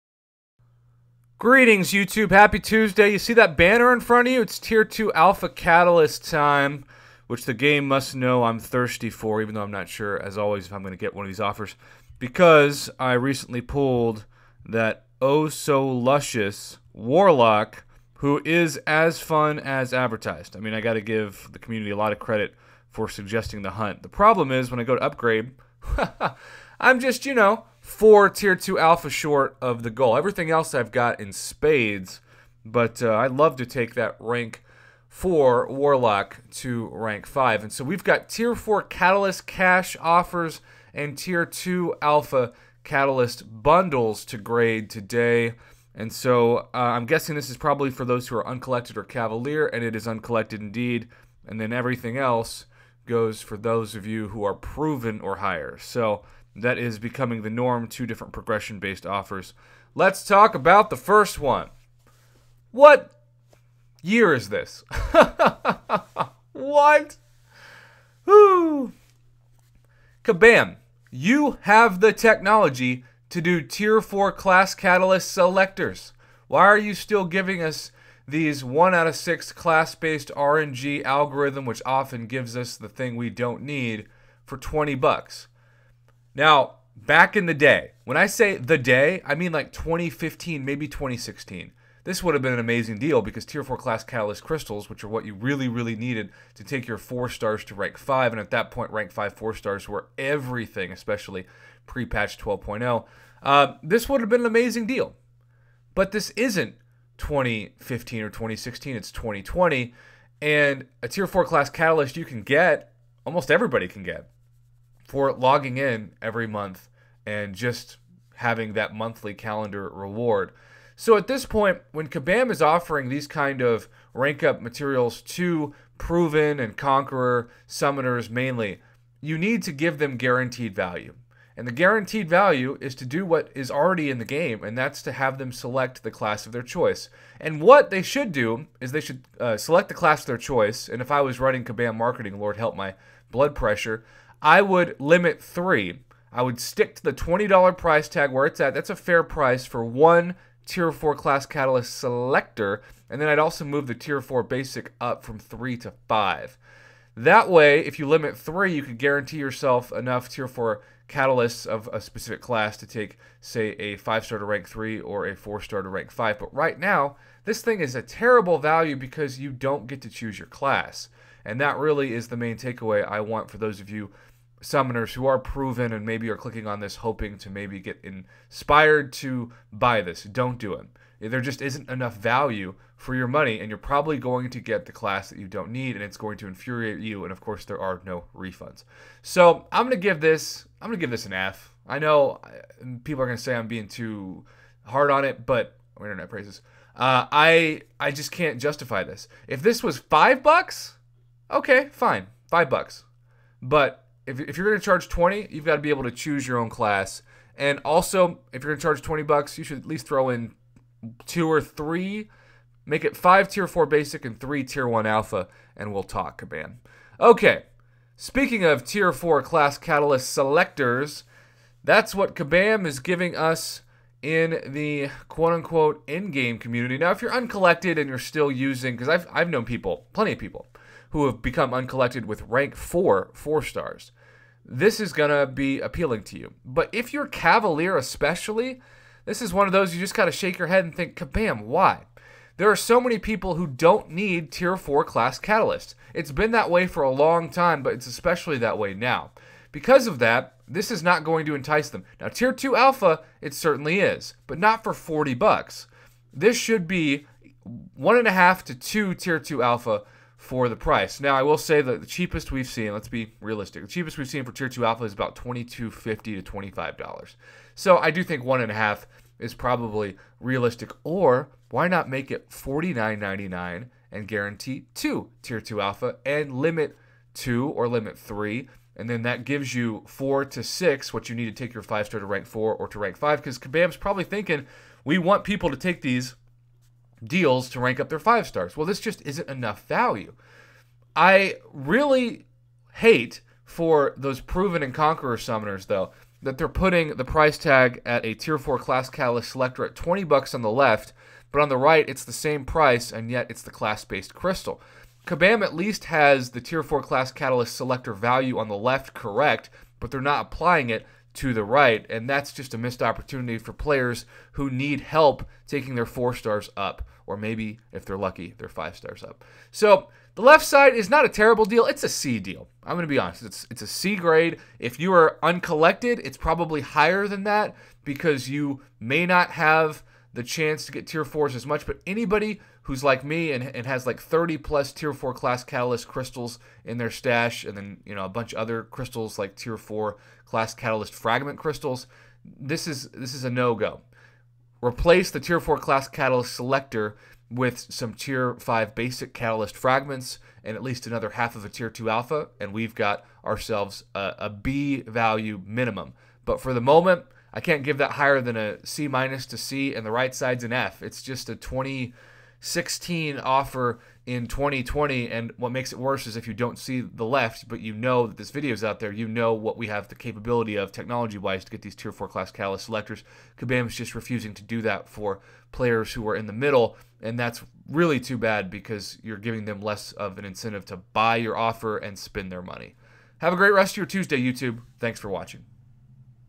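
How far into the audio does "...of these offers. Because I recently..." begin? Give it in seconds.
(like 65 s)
11 s.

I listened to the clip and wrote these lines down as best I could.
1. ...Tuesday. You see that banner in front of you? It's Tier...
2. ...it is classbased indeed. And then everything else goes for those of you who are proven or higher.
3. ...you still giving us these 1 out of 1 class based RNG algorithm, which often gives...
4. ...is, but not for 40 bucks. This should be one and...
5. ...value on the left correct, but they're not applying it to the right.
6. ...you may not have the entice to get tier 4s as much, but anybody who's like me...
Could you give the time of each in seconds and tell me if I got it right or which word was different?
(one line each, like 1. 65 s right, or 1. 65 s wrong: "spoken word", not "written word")
1. 2 s right
2. 49 s wrong: "uncollected", not "classbased"
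3. 76 s wrong: "6", not "1"
4. 253 s right
5. 308 s right
6. 328 s wrong: "chance", not "entice".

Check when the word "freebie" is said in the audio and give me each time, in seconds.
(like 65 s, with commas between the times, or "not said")
not said.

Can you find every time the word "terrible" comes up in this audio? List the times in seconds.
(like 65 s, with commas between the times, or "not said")
168 s, 321 s.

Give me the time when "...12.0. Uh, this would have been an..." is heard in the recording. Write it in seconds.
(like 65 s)
102 s.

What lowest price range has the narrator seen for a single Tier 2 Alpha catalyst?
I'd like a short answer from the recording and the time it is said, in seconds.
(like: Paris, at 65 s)
$22.50 to $25, at 265 s.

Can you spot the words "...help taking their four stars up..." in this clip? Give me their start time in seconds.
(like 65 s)
315 s.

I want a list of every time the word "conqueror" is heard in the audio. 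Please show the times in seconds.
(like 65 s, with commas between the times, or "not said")
126 s, 294 s.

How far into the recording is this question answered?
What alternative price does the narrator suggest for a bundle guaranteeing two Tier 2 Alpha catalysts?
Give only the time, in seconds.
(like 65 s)
272 s.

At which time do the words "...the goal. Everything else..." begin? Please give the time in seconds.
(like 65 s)
29 s.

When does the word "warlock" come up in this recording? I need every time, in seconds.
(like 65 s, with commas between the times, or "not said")
16 s, 35 s.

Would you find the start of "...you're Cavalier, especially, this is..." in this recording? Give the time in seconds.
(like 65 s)
237 s.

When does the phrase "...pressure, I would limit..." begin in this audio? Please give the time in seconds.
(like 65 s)
143 s.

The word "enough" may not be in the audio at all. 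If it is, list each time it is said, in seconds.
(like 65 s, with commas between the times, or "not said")
159 s, 181 s, 289 s.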